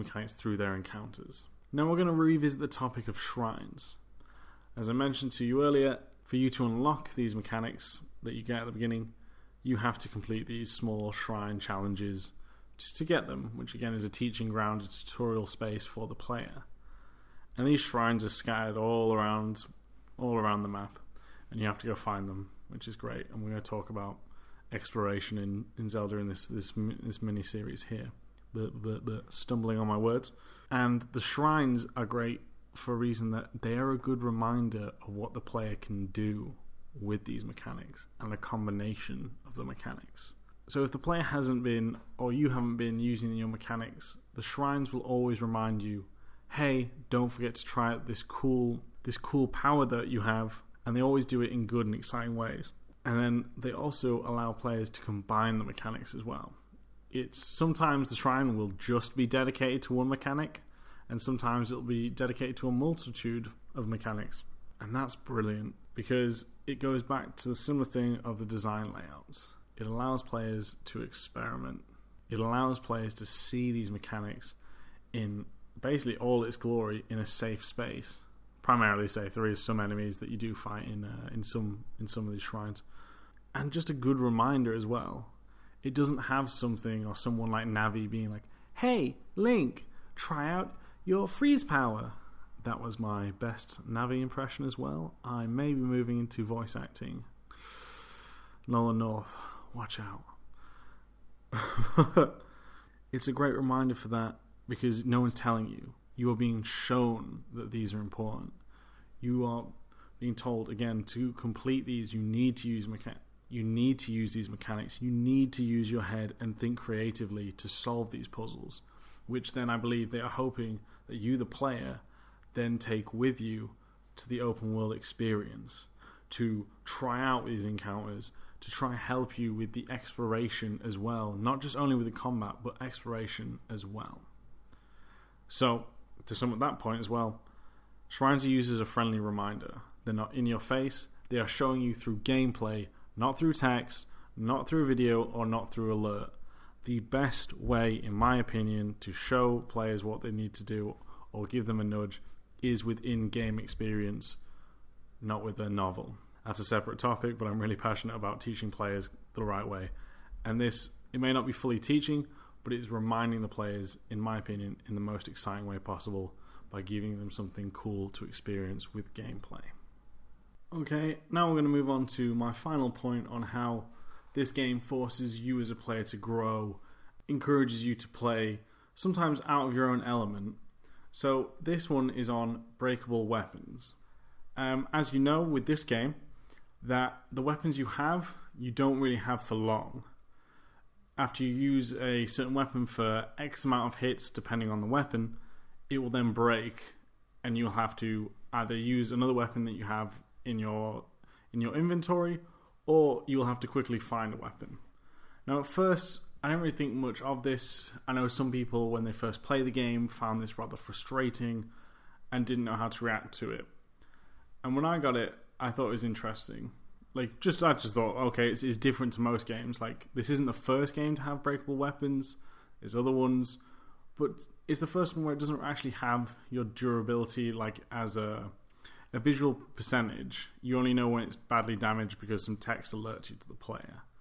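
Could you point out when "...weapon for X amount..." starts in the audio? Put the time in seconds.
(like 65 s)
192 s.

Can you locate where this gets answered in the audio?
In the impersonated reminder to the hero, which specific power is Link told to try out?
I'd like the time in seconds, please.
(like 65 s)
91 s.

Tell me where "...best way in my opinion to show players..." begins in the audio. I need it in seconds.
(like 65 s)
146 s.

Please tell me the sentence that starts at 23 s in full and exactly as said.
And we're going to talk about exploration in, in Zelda in this this this mini series here.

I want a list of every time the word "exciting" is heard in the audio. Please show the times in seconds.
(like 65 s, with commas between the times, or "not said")
51 s, 165 s.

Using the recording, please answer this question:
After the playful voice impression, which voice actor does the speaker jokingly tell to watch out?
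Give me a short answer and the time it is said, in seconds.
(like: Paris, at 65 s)
Nolan North, at 98 s.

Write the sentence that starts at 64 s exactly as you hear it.
And that's brilliant because it goes back to the similar thing of the design layouts.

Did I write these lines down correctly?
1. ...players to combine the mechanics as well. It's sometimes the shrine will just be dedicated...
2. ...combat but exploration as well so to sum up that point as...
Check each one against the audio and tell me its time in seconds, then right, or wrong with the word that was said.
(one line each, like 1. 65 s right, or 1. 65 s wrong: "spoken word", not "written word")
1. 54 s right
2. 132 s right.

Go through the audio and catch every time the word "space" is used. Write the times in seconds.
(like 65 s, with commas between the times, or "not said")
15 s, 77 s.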